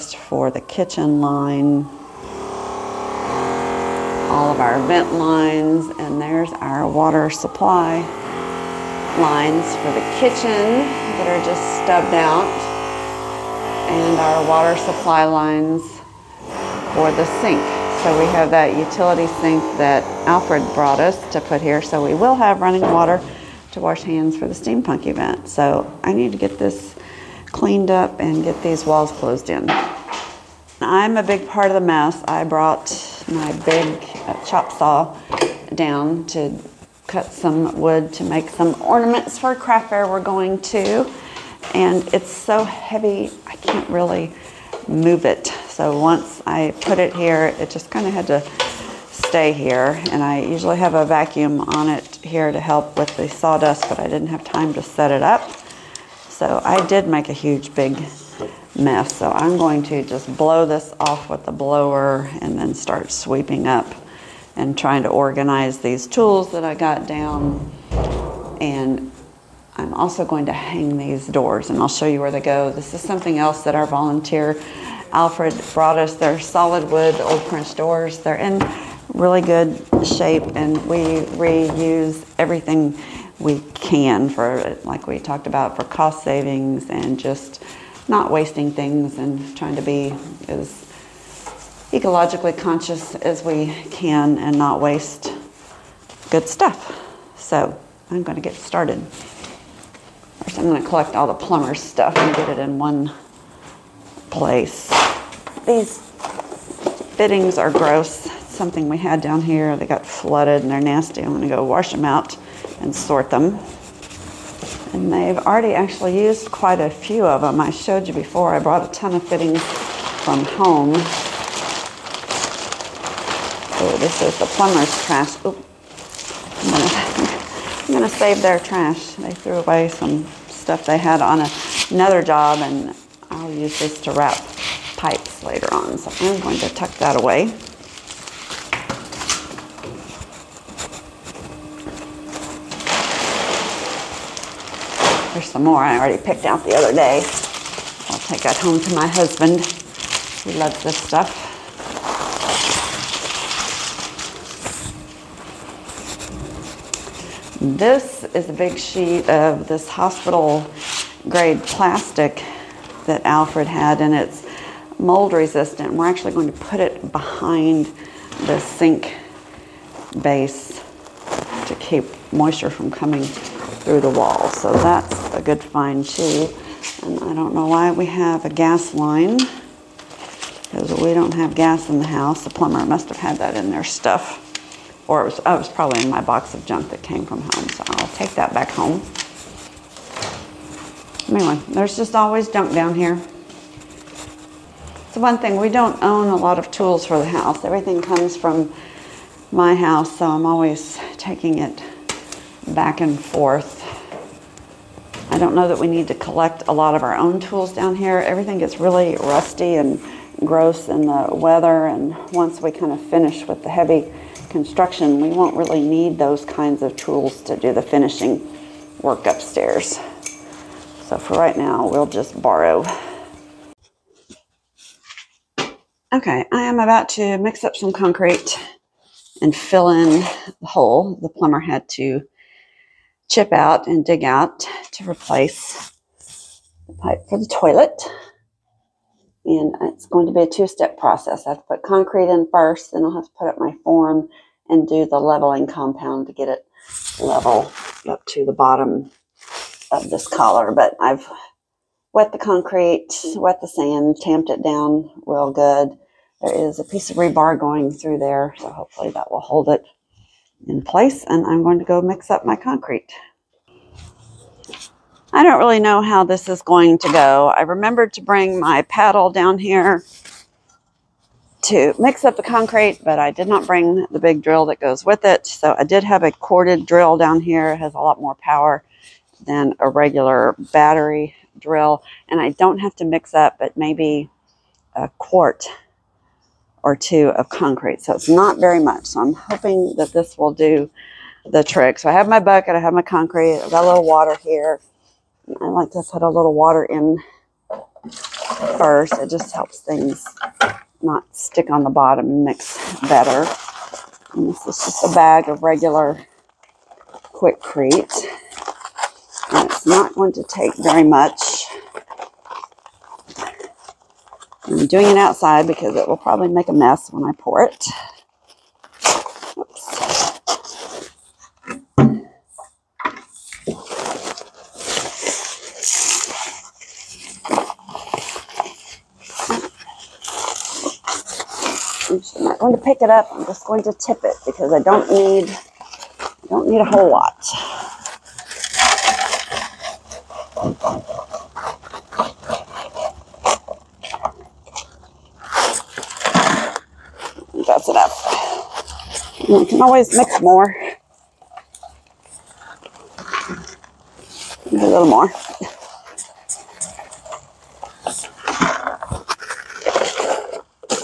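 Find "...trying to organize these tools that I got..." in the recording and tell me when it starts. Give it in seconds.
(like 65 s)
64 s.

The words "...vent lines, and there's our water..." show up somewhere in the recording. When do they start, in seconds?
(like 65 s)
4 s.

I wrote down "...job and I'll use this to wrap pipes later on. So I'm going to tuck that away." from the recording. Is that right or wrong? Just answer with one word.
right.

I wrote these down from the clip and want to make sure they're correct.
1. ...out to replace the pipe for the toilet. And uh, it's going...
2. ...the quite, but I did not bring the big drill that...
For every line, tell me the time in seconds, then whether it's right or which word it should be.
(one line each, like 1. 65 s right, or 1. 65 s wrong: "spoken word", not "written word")
1. 234 s right
2. 272 s wrong: "concrete", not "quite".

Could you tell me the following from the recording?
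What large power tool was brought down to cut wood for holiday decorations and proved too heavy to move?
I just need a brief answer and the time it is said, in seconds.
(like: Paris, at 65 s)
chop saw, at 34 s.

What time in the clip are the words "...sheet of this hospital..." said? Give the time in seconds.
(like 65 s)
158 s.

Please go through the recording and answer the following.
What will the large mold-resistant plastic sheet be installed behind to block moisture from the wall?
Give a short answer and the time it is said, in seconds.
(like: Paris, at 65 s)
sink base, at 168 s.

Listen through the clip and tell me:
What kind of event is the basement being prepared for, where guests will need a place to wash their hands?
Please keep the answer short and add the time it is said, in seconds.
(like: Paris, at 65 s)
steampunk event, at 24 s.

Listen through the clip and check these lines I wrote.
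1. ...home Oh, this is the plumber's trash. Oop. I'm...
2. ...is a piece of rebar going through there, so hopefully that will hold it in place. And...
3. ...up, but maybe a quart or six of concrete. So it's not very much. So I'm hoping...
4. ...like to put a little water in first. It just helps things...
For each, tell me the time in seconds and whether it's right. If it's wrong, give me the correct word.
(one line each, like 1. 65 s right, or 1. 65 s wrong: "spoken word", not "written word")
1. 120 s right
2. 256 s right
3. 283 s wrong: "two", not "six"
4. 295 s right.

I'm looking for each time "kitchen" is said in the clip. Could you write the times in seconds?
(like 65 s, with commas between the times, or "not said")
0 s, 10 s.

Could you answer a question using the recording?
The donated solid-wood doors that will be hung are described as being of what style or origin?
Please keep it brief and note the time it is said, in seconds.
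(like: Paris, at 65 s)
French, at 77 s.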